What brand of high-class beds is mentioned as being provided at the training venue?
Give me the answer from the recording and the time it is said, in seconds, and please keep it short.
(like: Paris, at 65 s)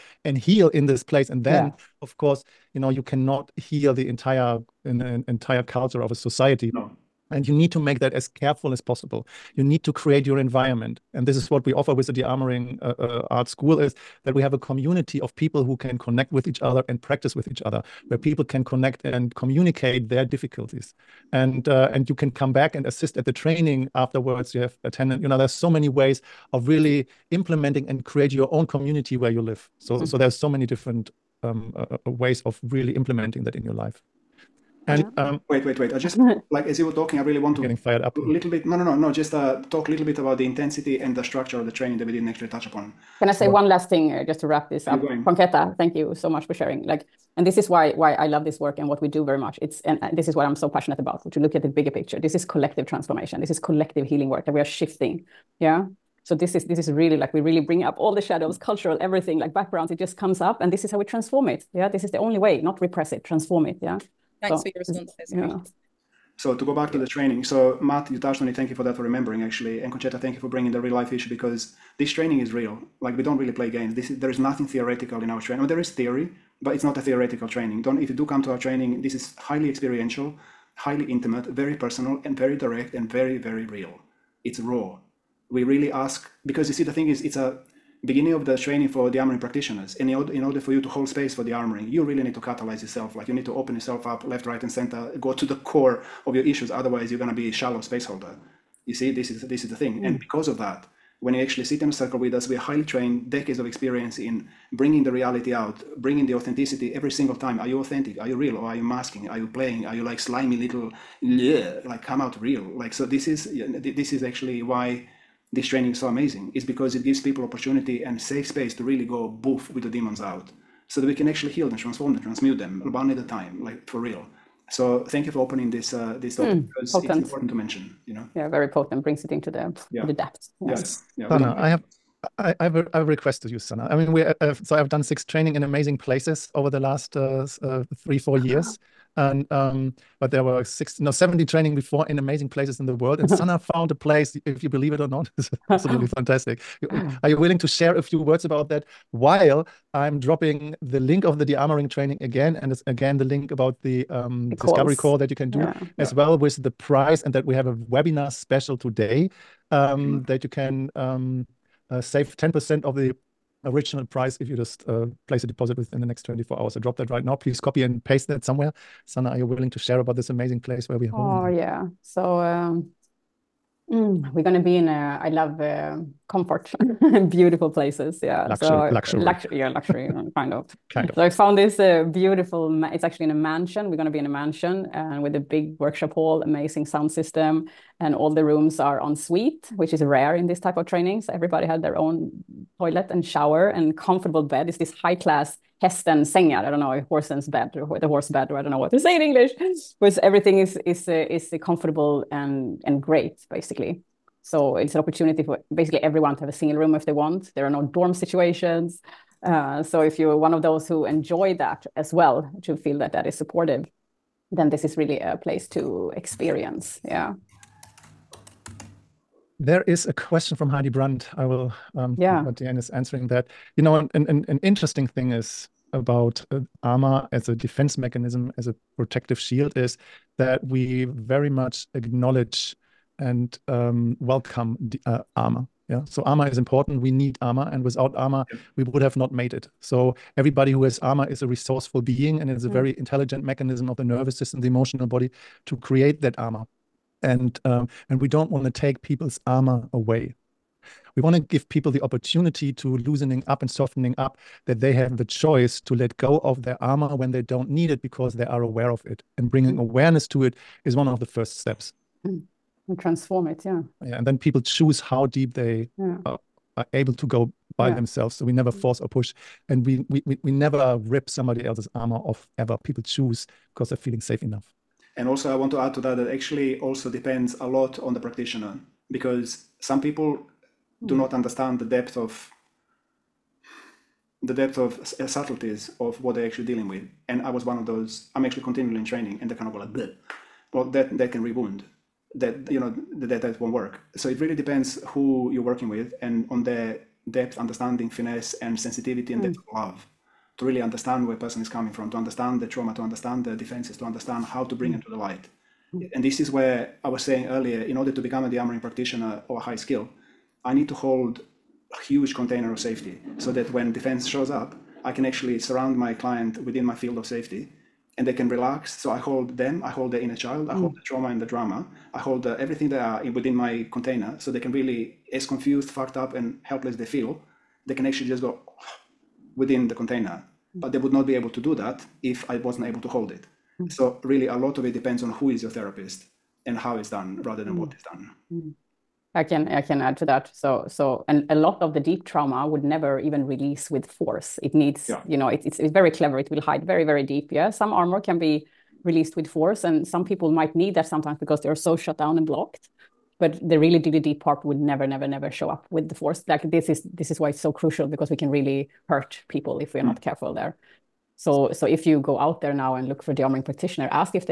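Hästens, at 195 s.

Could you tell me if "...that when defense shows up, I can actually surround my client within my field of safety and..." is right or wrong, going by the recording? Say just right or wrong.
right.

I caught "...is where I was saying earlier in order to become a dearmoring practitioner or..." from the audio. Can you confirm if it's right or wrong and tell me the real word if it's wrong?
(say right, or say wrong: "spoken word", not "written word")
right.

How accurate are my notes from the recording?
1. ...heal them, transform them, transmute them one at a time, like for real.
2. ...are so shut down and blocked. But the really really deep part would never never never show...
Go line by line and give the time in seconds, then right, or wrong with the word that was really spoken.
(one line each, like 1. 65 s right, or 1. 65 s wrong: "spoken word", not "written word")
1. 121 s right
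2. 351 s right.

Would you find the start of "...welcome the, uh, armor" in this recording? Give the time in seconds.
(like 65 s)
234 s.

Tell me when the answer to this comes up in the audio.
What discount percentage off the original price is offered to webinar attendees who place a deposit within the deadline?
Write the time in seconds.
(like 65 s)
162 s.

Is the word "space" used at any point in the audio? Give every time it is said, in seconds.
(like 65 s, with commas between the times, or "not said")
91 s, 97 s, 118 s.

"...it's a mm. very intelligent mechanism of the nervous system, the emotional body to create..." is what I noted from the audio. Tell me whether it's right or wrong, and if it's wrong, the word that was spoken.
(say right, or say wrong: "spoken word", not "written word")
right.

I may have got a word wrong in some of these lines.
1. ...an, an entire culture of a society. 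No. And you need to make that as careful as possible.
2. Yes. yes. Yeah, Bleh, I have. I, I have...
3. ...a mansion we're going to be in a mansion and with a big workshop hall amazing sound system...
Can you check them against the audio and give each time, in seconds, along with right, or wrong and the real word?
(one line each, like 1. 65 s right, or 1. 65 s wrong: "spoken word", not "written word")
1. 4 s right
2. 130 s wrong: "Sana", not "Bleh"
3. 183 s right.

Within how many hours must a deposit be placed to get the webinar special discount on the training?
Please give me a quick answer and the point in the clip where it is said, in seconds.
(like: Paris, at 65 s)
24, at 166 s.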